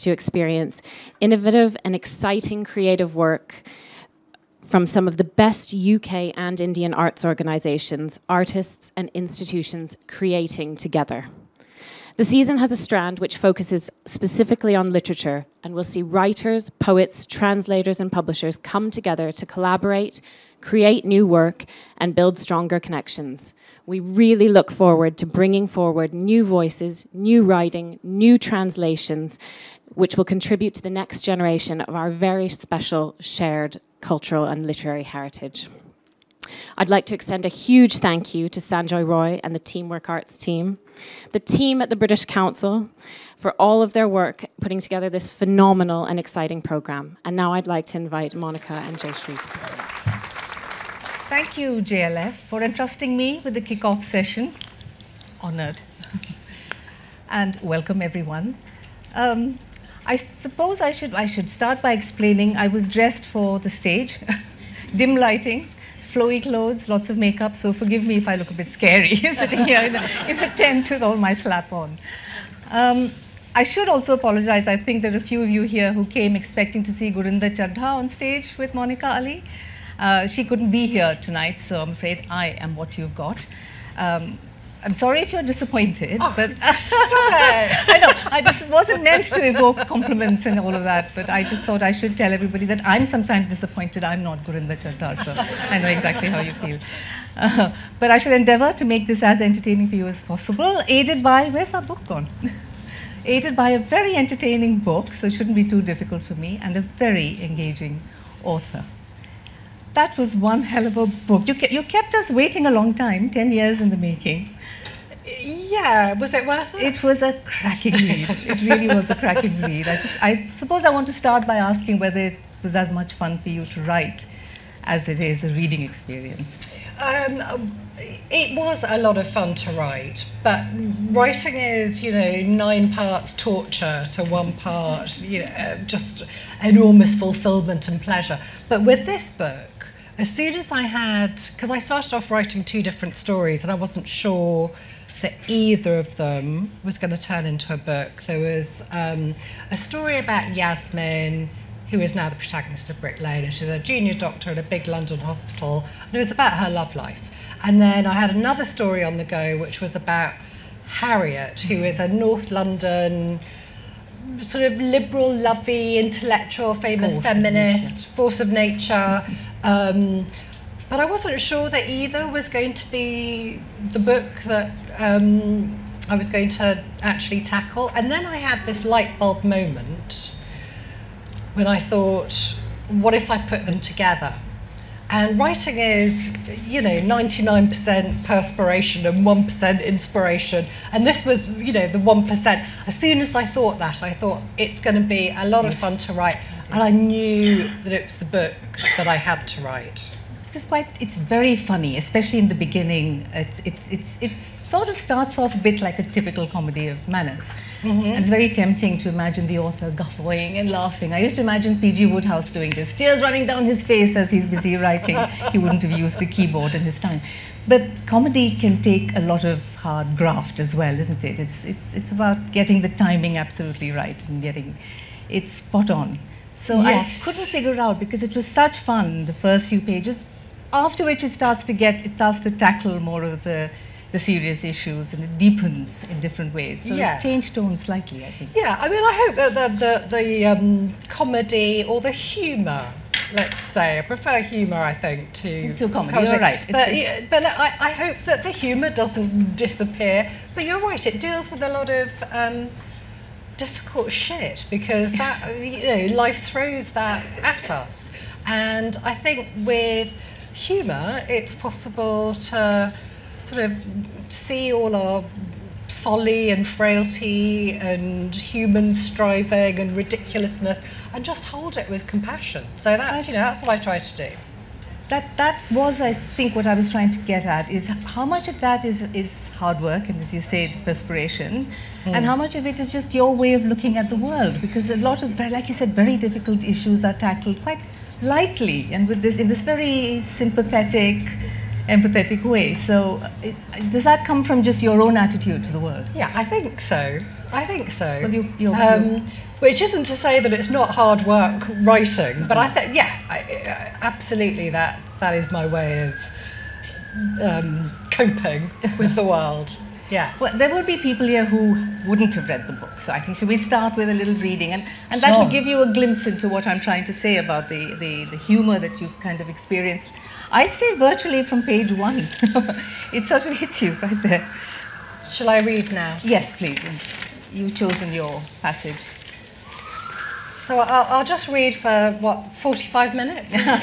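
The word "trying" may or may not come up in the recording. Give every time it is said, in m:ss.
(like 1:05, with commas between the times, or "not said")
4:36, 5:16.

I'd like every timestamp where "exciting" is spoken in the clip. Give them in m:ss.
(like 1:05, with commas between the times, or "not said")
0:01, 0:46.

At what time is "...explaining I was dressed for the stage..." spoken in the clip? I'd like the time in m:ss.
1:01.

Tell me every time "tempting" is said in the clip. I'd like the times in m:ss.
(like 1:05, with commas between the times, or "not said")
3:28.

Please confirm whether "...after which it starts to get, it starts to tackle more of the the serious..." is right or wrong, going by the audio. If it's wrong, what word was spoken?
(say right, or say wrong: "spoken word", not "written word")
right.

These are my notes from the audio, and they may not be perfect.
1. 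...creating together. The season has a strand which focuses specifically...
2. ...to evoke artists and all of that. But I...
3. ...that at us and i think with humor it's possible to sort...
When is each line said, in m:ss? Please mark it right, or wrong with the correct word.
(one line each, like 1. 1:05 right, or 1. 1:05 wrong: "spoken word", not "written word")
1. 0:10 right
2. 1:29 wrong: "compliments", not "artists"
3. 4:16 right.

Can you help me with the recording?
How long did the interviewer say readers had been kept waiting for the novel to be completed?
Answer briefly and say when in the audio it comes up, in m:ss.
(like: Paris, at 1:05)
10 years, at 1:53.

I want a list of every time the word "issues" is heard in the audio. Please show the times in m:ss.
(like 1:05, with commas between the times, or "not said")
3:54, 4:46.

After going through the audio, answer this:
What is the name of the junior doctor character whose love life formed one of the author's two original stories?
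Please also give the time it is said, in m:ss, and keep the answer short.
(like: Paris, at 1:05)
Yasmin, at 2:30.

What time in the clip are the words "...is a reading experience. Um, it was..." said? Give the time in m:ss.
2:05.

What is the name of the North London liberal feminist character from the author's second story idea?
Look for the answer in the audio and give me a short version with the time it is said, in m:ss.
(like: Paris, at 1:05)
Harriet, at 2:40.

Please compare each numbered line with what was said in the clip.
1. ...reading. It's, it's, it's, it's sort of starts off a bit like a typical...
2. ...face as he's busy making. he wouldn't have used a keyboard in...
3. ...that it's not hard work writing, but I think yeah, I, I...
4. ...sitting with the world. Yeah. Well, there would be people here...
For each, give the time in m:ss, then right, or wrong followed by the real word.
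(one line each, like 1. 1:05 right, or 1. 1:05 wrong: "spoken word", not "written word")
1. 3:22 wrong: "beginning", not "reading"
2. 3:33 wrong: "writing", not "making"
3. 5:00 right
4. 5:08 wrong: "coping", not "sitting".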